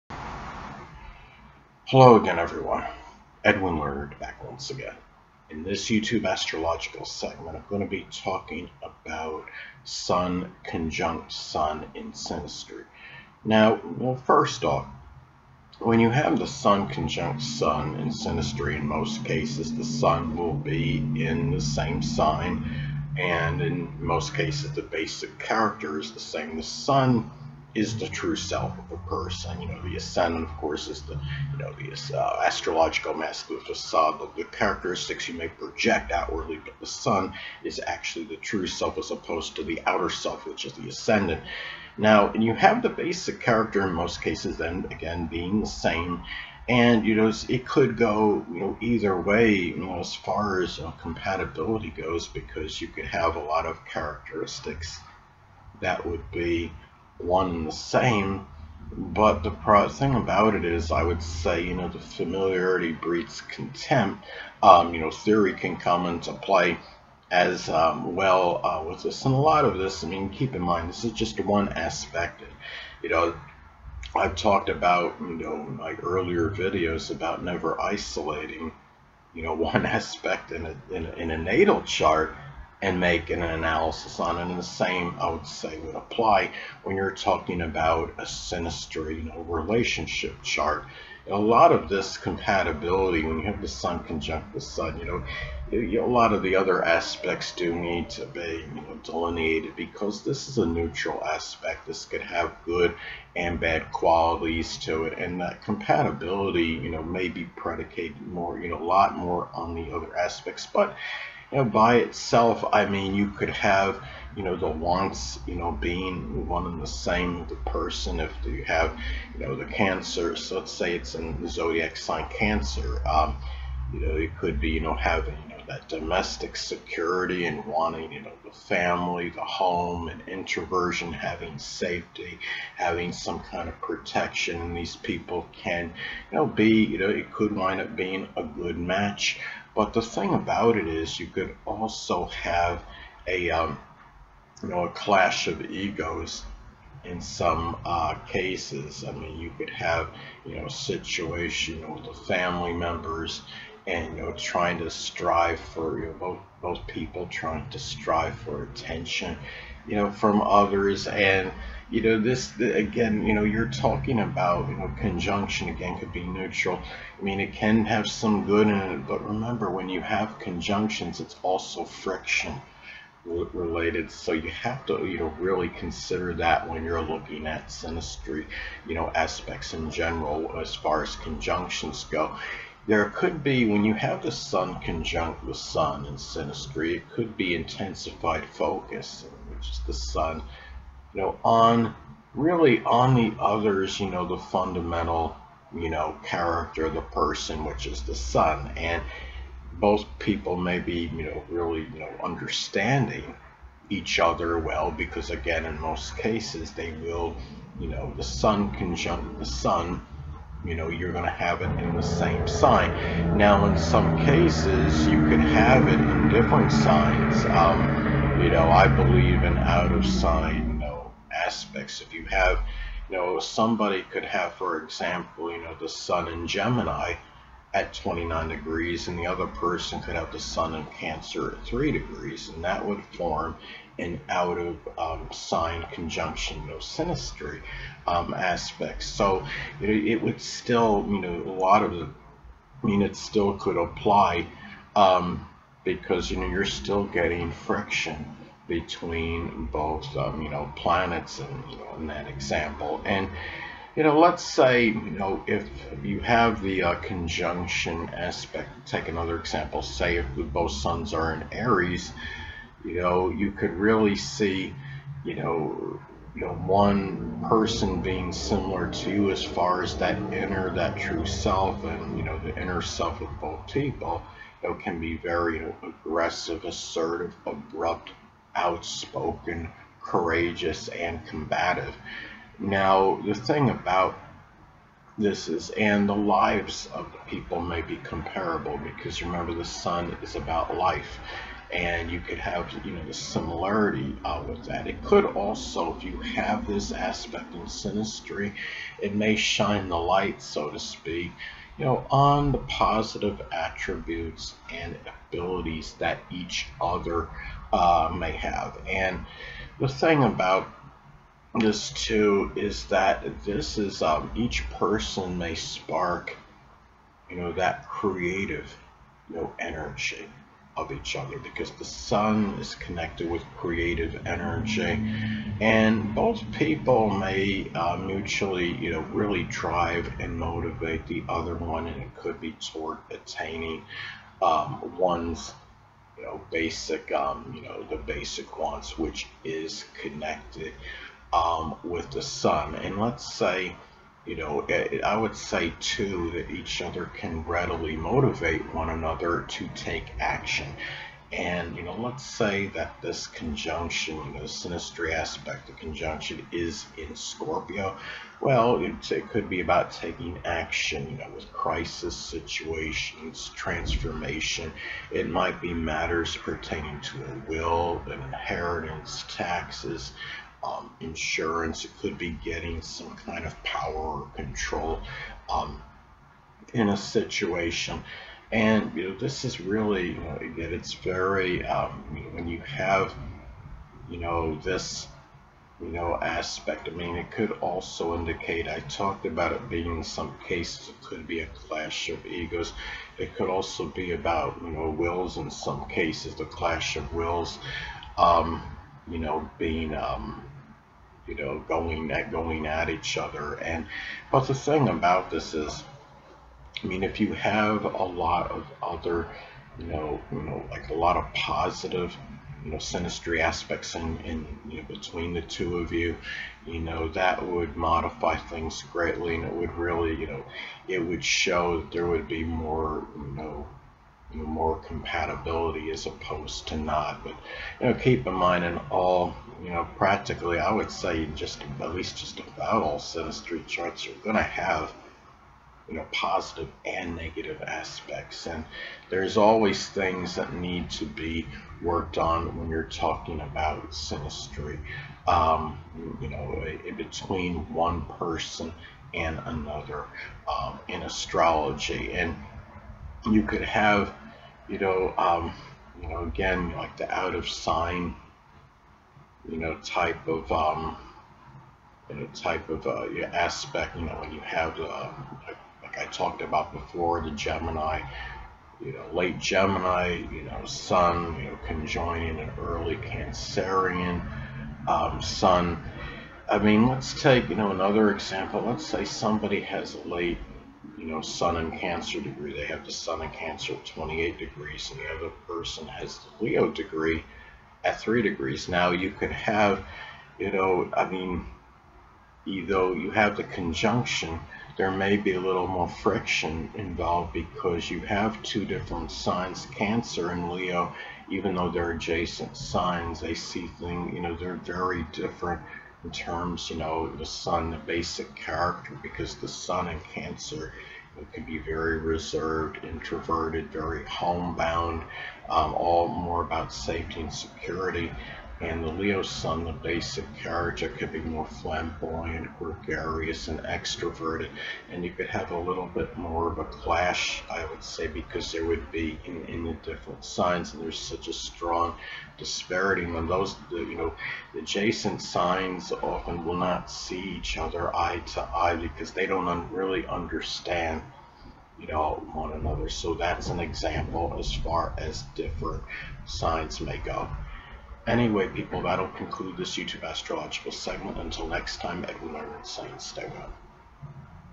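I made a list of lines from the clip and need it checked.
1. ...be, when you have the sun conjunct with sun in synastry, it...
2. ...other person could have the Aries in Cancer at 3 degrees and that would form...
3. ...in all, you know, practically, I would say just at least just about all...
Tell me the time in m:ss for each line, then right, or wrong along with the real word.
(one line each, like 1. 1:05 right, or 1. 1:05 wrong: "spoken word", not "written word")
1. 3:03 right
2. 3:49 wrong: "Sun", not "Aries"
3. 7:08 right.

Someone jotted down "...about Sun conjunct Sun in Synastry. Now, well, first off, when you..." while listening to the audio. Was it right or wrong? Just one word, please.
right.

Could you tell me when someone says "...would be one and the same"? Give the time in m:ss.
0:56.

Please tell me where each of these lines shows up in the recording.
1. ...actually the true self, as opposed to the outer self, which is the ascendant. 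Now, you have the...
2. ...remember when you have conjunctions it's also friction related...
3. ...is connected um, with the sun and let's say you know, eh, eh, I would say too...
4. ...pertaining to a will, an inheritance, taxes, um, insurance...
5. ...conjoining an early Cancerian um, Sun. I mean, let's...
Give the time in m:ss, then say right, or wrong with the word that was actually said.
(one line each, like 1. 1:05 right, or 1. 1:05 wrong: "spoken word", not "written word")
1. 0:37 right
2. 2:49 right
3. 5:39 right
4. 6:06 right
5. 7:51 right.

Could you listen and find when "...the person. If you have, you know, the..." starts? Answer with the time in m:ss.
1:57.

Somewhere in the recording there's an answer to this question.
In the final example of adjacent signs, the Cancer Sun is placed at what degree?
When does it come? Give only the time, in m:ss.
8:03.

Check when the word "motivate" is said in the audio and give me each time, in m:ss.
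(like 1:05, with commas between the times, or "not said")
5:30, 5:47.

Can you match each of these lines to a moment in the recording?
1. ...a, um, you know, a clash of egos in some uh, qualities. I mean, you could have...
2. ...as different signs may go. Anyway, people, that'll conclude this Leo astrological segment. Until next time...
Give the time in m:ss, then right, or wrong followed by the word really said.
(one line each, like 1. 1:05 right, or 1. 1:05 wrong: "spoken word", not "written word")
1. 2:23 wrong: "cases", not "qualities"
2. 9:04 wrong: "YouTube", not "Leo".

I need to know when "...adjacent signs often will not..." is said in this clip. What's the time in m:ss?
8:54.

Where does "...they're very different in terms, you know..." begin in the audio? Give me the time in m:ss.
8:24.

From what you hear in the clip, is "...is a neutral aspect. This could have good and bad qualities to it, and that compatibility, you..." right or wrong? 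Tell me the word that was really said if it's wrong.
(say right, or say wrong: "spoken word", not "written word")
right.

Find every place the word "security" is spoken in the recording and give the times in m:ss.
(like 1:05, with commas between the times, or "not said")
2:06, 8:37.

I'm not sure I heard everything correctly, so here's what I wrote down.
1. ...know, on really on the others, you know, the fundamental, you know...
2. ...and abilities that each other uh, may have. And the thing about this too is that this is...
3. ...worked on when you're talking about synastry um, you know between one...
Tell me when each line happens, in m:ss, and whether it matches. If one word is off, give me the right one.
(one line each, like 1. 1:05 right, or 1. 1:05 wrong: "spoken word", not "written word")
1. 3:11 right
2. 5:04 right
3. 7:21 right.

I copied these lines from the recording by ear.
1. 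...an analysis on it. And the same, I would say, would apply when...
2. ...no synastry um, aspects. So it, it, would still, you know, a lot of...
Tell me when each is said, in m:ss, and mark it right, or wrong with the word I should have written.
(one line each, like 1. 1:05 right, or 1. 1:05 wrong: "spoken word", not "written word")
1. 1:23 right
2. 3:56 right.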